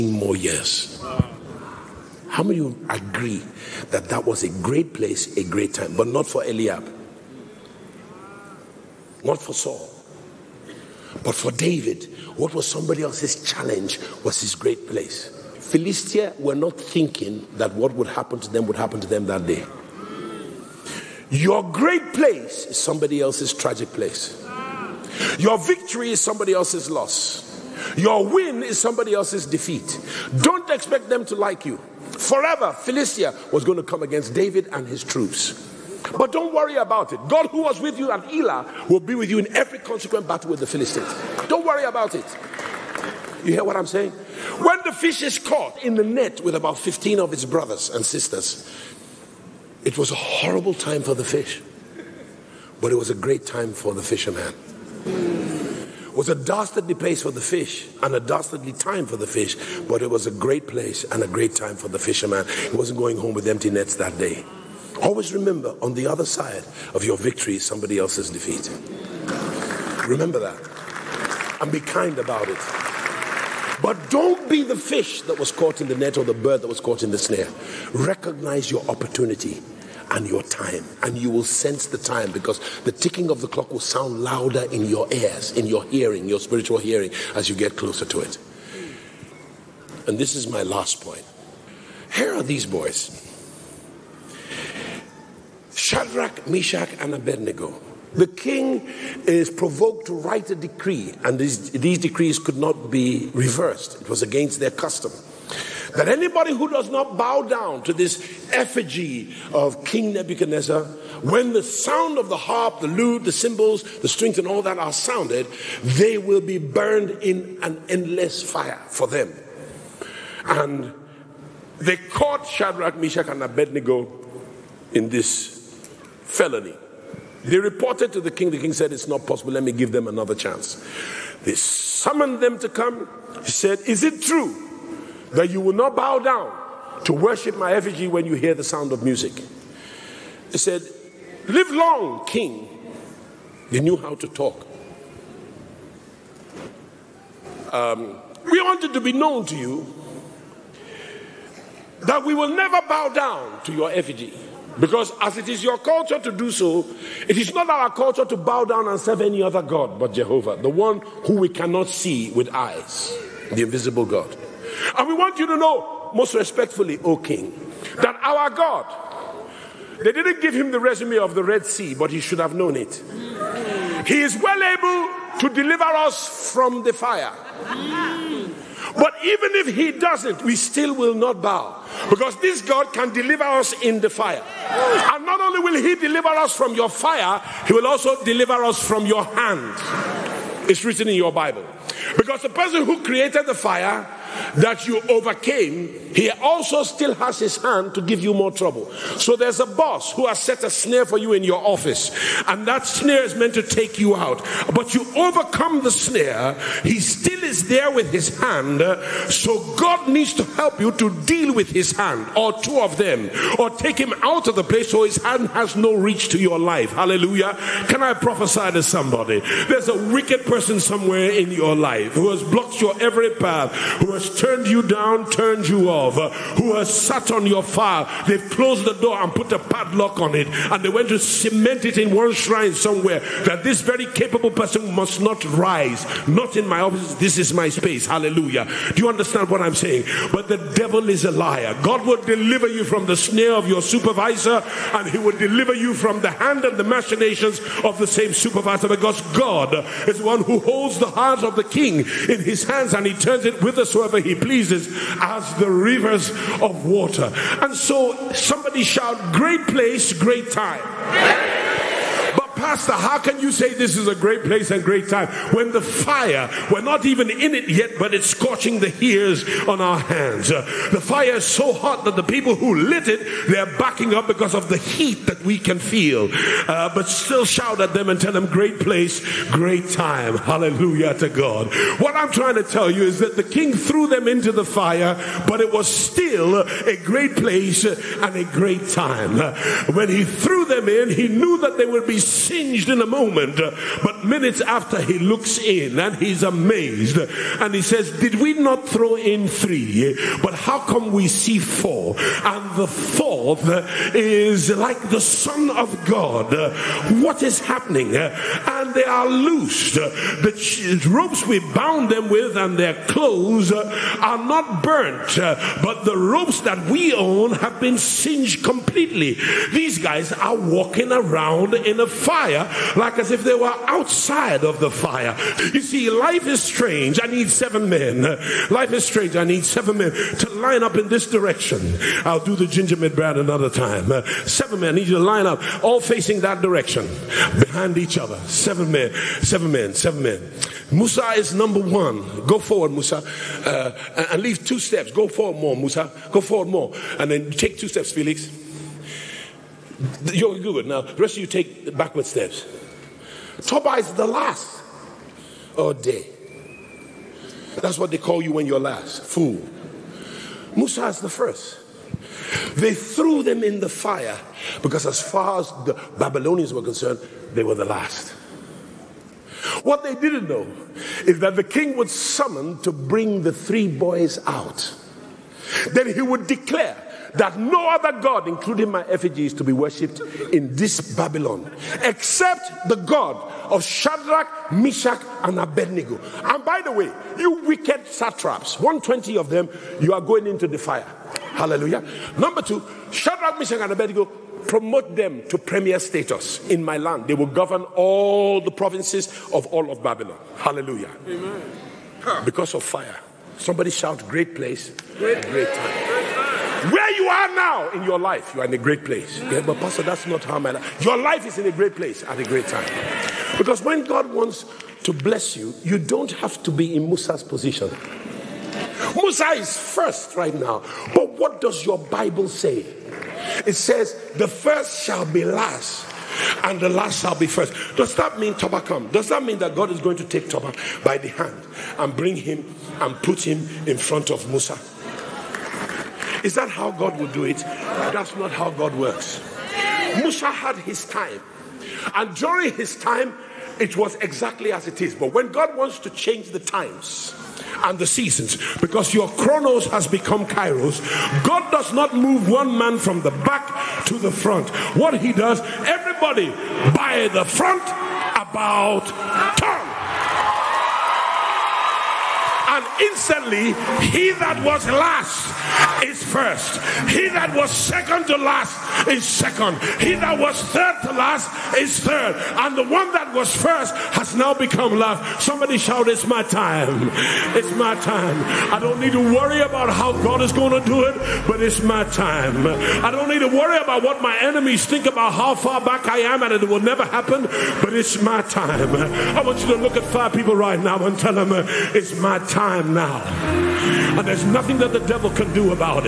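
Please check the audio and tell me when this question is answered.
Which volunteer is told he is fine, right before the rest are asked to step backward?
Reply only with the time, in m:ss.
5:48.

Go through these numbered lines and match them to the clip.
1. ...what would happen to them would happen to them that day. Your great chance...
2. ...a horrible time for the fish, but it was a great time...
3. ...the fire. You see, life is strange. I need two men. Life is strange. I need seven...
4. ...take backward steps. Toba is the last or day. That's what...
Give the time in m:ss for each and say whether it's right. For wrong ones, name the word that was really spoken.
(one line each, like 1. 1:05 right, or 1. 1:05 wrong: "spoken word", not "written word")
1. 0:17 wrong: "place", not "chance"
2. 0:50 right
3. 5:24 wrong: "seven", not "two"
4. 5:51 right.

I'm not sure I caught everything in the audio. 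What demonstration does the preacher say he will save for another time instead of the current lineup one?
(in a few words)
the gingerbread.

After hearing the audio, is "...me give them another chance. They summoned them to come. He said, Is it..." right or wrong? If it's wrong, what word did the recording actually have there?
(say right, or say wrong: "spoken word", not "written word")
right.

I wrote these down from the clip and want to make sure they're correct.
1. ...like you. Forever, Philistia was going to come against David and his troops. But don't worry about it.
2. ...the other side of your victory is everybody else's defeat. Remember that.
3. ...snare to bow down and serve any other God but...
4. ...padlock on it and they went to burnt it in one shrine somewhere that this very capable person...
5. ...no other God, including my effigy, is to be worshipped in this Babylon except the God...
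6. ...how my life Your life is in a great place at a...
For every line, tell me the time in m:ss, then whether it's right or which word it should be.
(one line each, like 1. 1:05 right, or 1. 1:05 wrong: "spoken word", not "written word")
1. 0:31 right
2. 1:05 wrong: "somebody", not "everybody"
3. 2:37 wrong: "culture", not "snare"
4. 3:49 wrong: "cement", not "burnt"
5. 6:17 right
6. 6:50 right.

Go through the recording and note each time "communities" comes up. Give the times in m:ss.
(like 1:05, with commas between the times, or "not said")
not said.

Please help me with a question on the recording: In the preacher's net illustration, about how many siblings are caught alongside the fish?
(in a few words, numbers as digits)
15.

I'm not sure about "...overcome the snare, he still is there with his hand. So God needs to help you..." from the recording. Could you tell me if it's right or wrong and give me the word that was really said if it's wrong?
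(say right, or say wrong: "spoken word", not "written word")
right.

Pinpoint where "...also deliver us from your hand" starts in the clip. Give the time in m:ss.
3:07.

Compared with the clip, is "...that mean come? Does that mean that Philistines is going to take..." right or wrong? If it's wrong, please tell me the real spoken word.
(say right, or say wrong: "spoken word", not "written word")
wrong: "God", not "Philistines".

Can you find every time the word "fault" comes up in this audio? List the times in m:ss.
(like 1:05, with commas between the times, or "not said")
not said.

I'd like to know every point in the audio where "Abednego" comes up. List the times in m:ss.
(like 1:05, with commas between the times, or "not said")
1:37, 2:03, 6:25, 6:33.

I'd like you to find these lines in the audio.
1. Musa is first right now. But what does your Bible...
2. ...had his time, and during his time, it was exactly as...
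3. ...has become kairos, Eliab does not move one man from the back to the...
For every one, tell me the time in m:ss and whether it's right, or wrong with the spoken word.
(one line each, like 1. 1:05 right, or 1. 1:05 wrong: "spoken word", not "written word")
1. 6:59 right
2. 7:20 right
3. 7:29 wrong: "God", not "Eliab".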